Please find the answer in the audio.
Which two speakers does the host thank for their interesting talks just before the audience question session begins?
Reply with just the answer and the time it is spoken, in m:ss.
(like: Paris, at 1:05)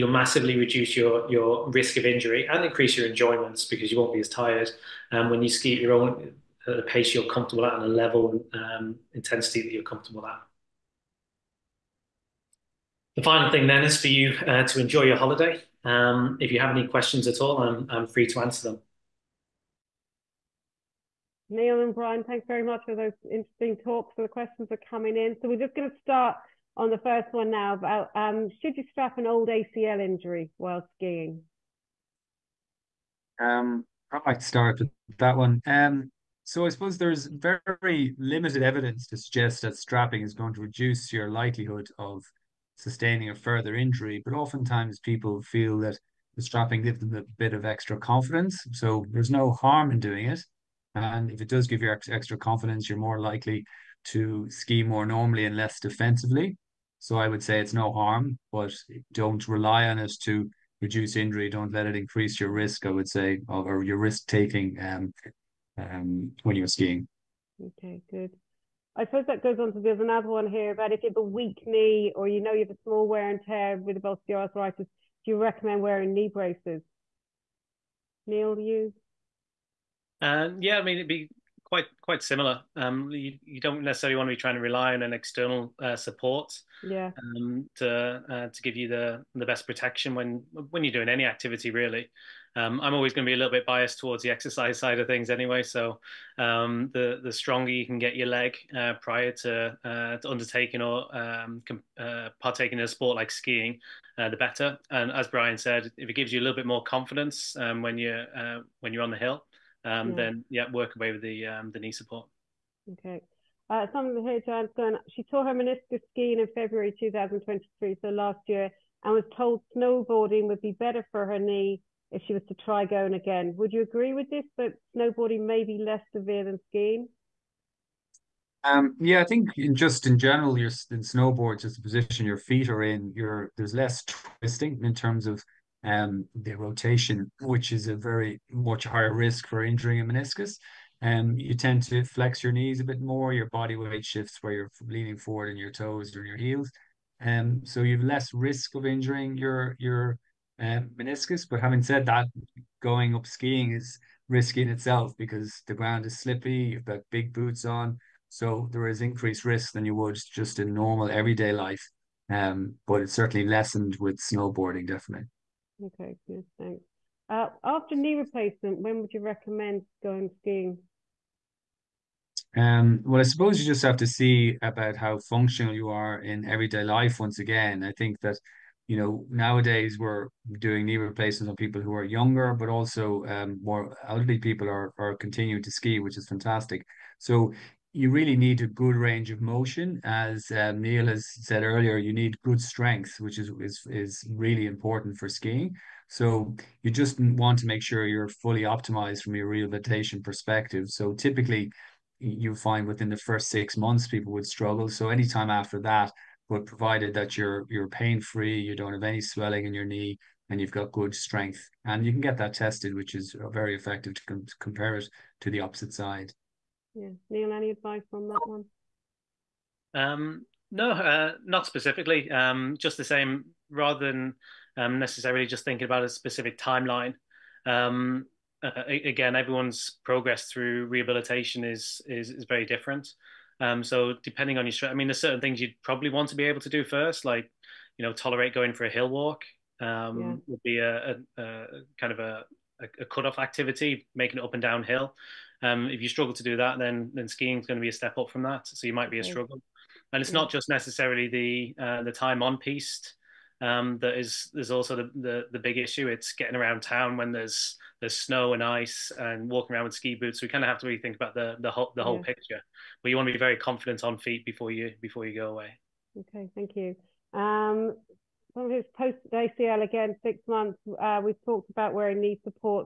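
Neil and Brian, at 0:21.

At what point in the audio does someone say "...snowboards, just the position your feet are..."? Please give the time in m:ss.
2:11.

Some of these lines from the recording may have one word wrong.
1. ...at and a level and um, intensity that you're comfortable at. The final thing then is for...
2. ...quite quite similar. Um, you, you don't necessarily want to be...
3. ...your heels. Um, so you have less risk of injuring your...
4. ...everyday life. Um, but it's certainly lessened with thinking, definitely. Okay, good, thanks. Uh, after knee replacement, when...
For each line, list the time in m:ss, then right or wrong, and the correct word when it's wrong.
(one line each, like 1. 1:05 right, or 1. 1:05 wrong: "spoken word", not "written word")
1. 0:07 right
2. 1:21 right
3. 2:26 right
4. 2:41 wrong: "snowboarding", not "thinking".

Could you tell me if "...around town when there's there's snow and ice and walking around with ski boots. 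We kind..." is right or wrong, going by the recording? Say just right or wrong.
right.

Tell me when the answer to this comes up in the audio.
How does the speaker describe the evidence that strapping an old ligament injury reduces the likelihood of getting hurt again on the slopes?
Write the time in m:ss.
0:37.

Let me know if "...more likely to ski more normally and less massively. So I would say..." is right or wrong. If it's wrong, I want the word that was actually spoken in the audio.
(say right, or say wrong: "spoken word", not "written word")
wrong: "defensively", not "massively".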